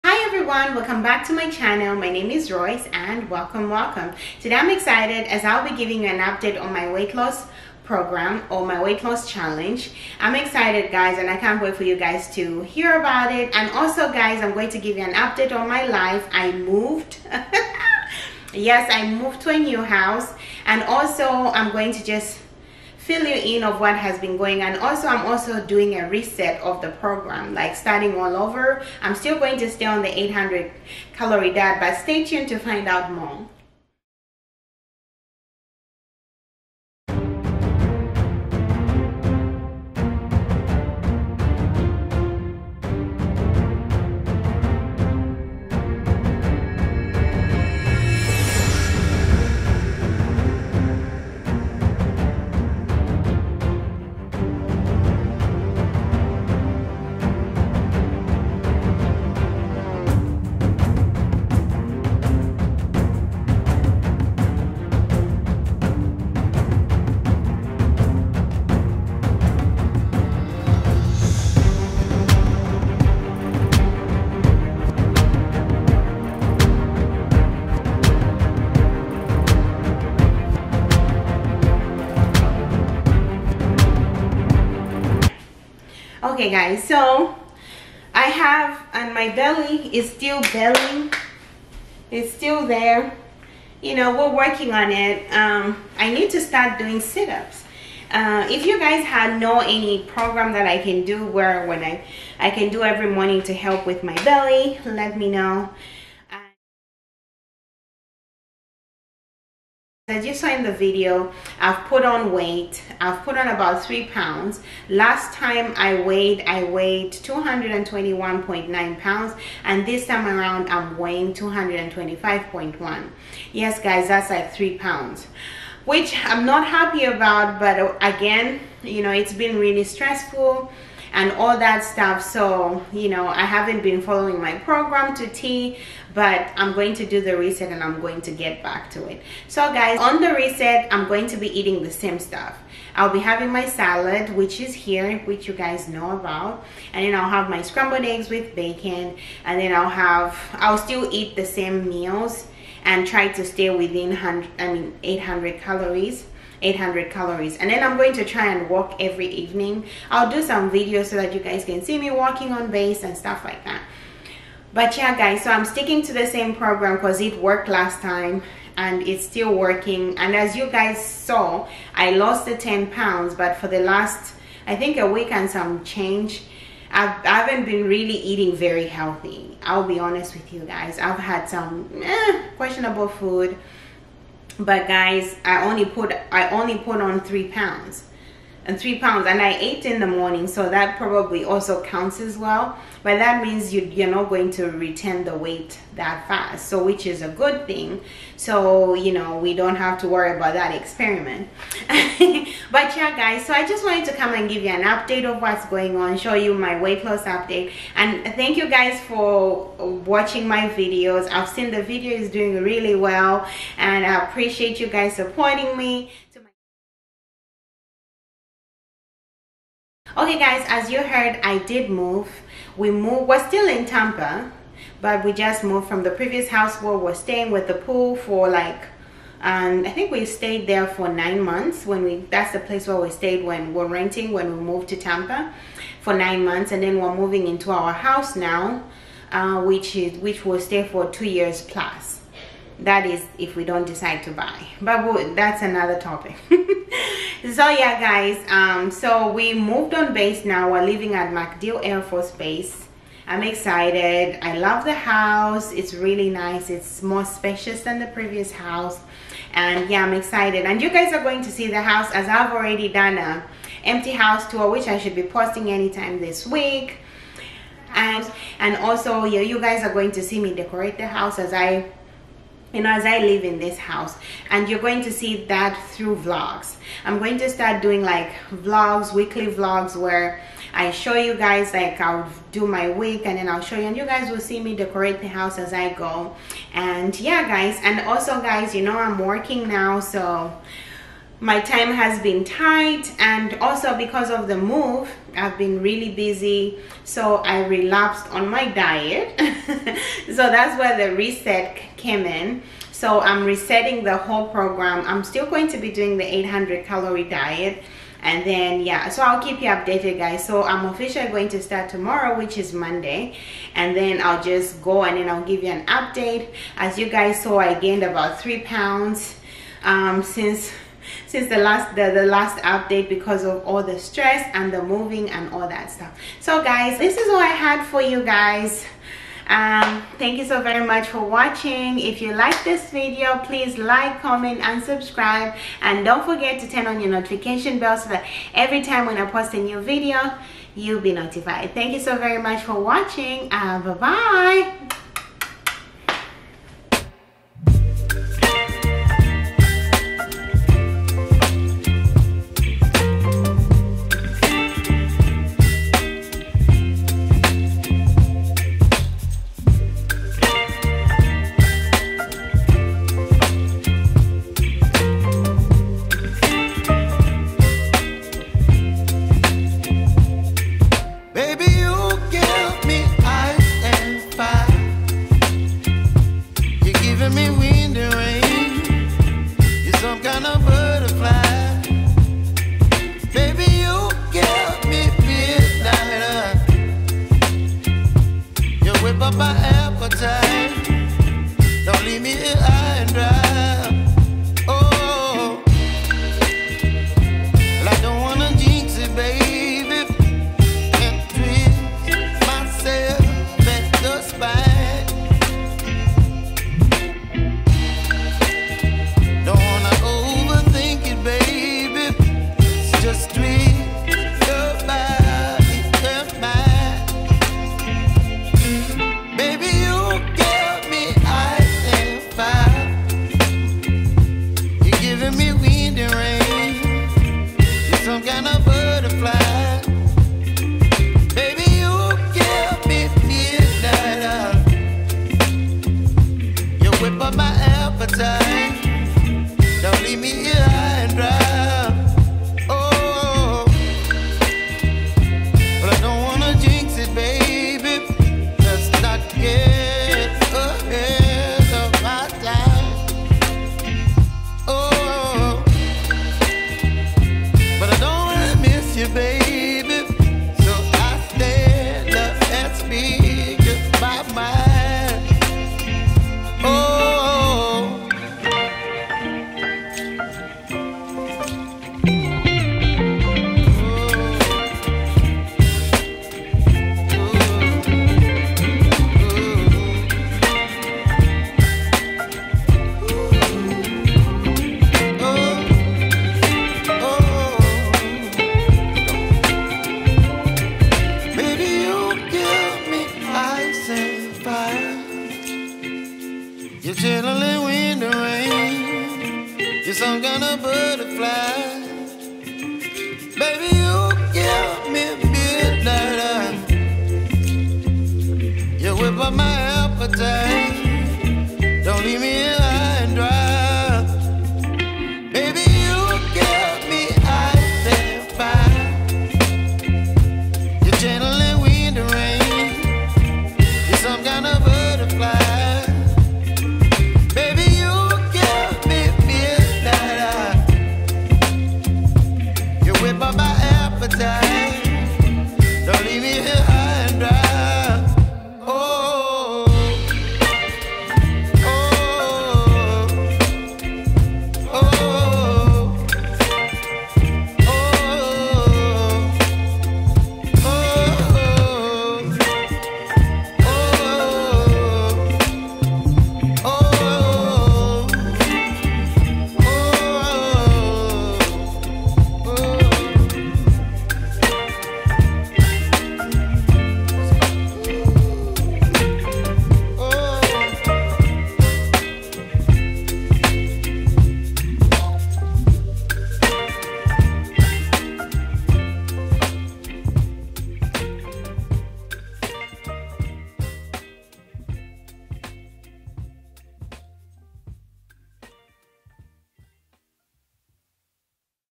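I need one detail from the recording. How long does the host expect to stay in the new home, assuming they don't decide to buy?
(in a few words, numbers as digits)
2 years.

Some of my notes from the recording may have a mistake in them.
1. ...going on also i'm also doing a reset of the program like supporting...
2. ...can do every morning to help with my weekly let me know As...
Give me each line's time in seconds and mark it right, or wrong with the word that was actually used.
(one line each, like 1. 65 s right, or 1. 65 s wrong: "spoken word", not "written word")
1. 24 s wrong: "starting", not "supporting"
2. 102 s wrong: "belly", not "weekly".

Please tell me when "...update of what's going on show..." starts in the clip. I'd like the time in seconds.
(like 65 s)
204 s.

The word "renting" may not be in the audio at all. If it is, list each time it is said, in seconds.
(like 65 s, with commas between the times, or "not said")
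233 s.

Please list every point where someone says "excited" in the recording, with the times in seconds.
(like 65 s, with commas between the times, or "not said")
4 s, 10 s, 253 s, 260 s.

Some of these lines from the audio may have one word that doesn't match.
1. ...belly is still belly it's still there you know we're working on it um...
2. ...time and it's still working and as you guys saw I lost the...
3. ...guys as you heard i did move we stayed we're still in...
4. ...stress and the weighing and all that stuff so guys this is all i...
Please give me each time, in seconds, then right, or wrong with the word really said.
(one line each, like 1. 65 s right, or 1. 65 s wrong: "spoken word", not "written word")
1. 89 s right
2. 168 s right
3. 220 s wrong: "moved", not "stayed"
4. 323 s wrong: "moving", not "weighing".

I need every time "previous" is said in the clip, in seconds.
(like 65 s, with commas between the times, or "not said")
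226 s, 258 s.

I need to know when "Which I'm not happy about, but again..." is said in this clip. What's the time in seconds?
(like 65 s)
125 s.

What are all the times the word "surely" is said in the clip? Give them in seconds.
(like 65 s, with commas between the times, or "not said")
not said.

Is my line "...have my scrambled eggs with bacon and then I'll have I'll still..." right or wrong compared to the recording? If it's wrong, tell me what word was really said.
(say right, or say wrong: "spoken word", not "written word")
right.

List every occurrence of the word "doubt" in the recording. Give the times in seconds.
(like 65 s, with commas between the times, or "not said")
not said.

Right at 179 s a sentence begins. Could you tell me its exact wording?
I'll be honest with you guys.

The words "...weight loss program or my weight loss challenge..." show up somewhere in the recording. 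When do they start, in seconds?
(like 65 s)
6 s.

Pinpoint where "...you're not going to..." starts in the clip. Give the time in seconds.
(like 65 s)
193 s.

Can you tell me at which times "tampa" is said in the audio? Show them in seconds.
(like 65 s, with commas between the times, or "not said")
223 s, 234 s.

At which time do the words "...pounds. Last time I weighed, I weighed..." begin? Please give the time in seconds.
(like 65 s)
114 s.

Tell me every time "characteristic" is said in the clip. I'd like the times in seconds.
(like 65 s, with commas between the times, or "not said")
not said.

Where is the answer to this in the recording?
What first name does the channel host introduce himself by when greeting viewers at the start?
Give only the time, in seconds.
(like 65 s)
2 s.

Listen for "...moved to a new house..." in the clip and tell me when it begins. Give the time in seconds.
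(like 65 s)
19 s.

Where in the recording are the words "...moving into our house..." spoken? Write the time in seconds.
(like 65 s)
237 s.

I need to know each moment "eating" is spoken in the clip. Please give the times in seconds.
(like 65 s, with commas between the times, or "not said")
141 s, 178 s.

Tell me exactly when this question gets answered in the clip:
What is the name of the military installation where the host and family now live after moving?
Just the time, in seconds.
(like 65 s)
251 s.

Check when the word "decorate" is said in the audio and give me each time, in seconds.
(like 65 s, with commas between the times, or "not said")
270 s, 284 s.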